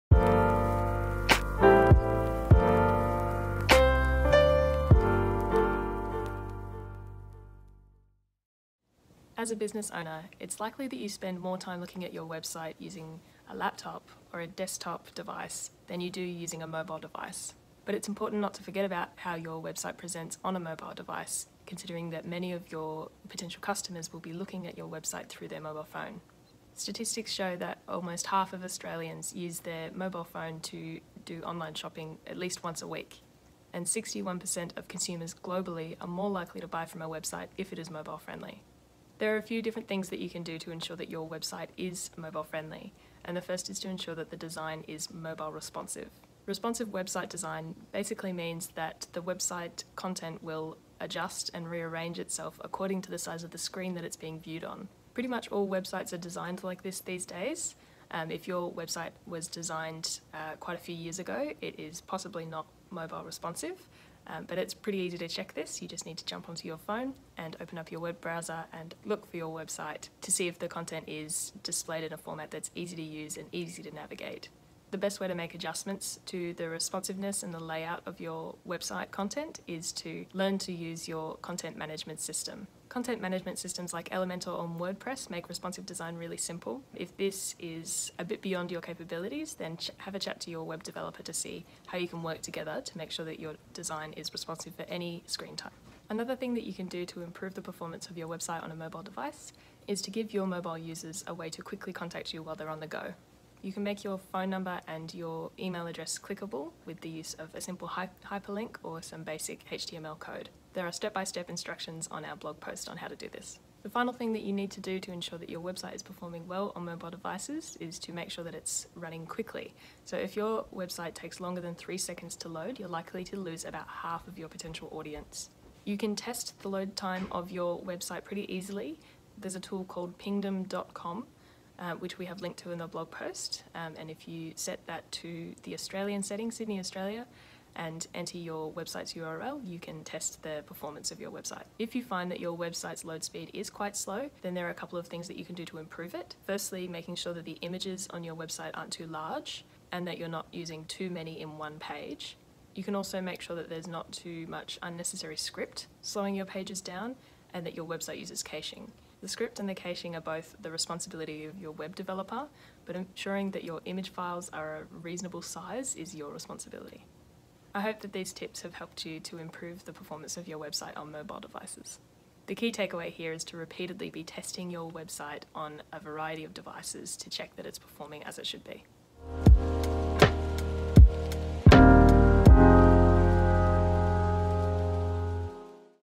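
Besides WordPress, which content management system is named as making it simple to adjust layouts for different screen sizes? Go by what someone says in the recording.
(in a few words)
Elementor.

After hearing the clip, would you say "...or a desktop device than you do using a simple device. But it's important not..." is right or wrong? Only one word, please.
wrong.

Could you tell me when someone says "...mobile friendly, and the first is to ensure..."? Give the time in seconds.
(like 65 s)
42 s.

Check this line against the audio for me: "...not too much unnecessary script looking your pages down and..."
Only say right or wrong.
wrong.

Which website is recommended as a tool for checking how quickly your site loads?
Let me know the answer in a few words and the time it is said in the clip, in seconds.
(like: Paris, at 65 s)
pingdom.com, at 130 s.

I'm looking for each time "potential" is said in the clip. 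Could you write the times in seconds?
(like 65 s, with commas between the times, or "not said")
23 s, 124 s.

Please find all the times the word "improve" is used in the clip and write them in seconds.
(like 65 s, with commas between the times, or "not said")
97 s, 145 s, 169 s.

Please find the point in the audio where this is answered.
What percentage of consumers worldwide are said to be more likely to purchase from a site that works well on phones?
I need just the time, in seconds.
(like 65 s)
33 s.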